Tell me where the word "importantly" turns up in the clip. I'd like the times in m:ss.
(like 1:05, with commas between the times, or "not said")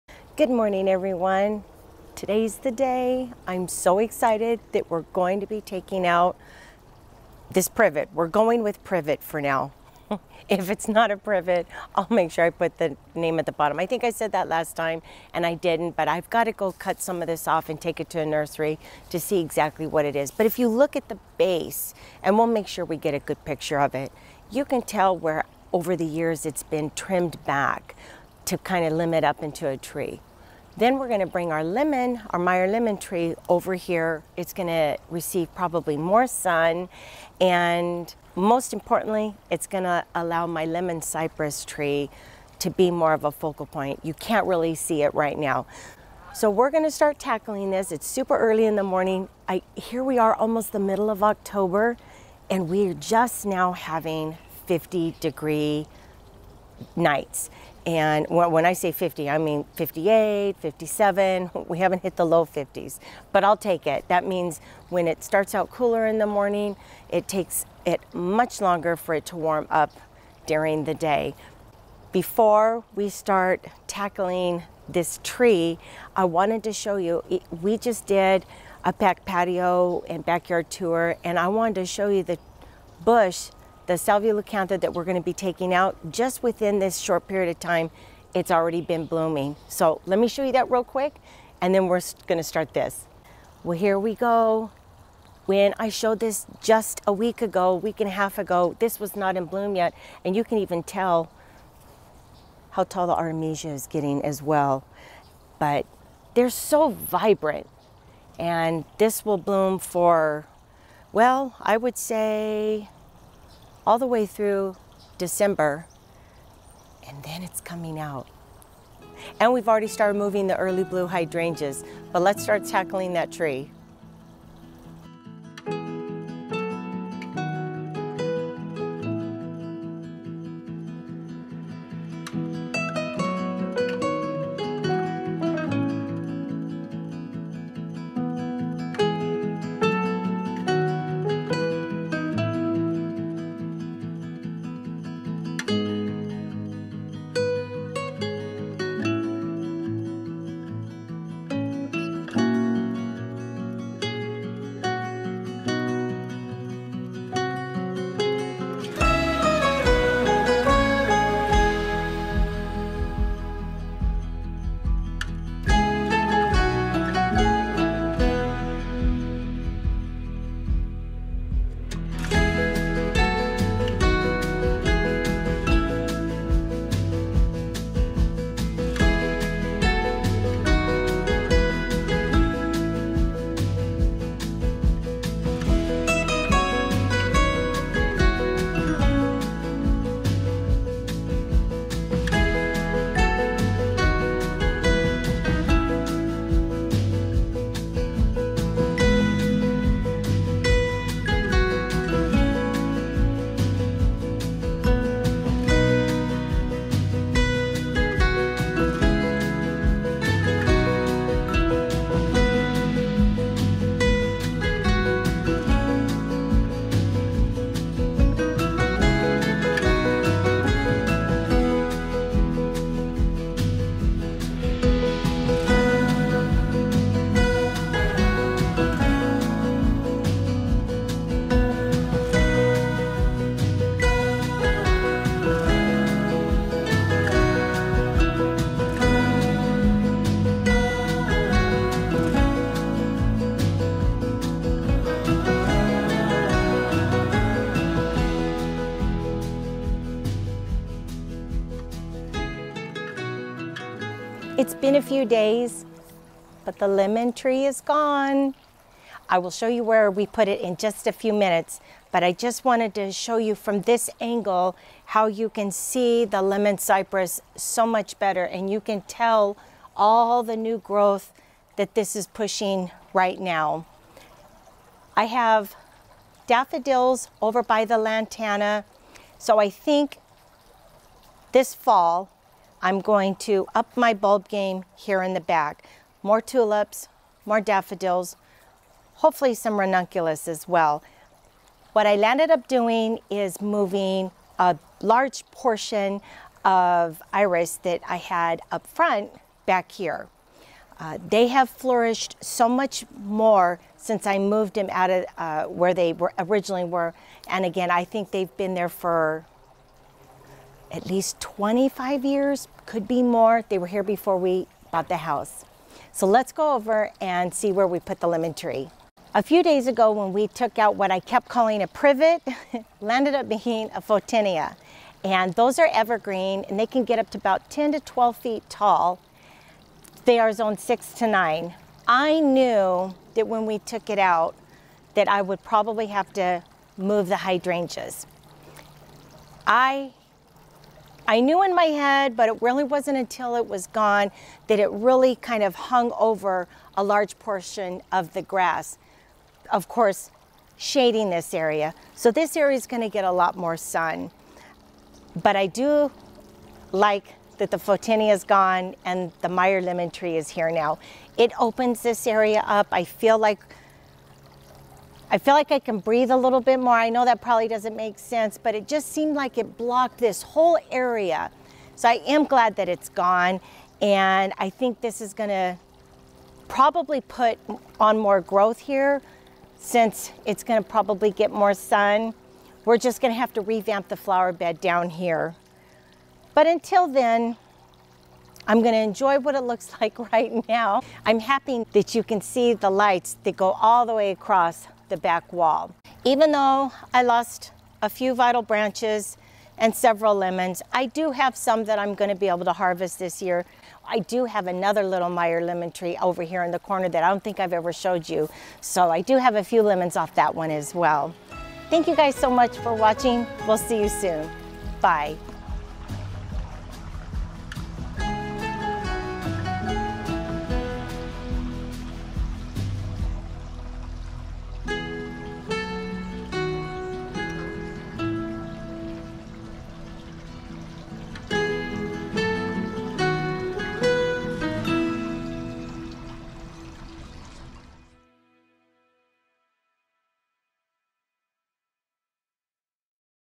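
0:38.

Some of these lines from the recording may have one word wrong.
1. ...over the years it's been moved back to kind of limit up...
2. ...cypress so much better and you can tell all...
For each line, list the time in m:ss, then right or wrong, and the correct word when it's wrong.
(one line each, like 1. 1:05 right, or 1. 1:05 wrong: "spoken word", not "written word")
1. 0:25 wrong: "trimmed", not "moved"
2. 4:26 right.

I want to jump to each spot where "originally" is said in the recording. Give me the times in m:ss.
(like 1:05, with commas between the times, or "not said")
5:06.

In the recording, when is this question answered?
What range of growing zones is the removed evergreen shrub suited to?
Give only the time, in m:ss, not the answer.
5:30.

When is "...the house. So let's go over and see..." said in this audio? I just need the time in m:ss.
5:15.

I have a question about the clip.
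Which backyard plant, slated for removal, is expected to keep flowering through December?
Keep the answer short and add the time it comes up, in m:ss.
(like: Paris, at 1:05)
Salvia leucantha, at 1:23.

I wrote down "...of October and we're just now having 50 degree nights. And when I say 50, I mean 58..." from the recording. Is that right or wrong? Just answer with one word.
right.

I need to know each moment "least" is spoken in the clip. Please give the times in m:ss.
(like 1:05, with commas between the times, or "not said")
5:11.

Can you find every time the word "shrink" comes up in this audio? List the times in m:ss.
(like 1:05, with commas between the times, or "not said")
not said.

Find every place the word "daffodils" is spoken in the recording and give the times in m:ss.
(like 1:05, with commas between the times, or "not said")
4:36, 4:47.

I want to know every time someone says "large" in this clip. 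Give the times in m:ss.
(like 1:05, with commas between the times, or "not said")
4:55, 5:47.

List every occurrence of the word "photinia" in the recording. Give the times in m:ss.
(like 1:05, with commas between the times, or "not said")
5:24, 5:57.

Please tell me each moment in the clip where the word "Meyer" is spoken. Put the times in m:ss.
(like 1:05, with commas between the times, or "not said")
0:32, 5:59, 6:45.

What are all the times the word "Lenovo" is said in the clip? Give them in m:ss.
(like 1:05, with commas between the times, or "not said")
not said.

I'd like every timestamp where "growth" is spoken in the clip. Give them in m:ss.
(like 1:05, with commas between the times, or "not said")
4:30, 6:18.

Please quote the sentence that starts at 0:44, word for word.
You can't really see it right now.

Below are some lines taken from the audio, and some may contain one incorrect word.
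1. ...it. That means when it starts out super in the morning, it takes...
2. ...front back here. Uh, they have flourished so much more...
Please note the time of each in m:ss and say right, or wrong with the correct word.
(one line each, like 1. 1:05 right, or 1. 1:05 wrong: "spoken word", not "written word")
1. 1:03 wrong: "cooler", not "super"
2. 4:58 right.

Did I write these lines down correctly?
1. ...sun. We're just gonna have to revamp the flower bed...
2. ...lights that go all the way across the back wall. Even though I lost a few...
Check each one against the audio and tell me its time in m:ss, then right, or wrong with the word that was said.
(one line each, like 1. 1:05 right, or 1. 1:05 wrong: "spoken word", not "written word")
1. 6:21 right
2. 6:32 right.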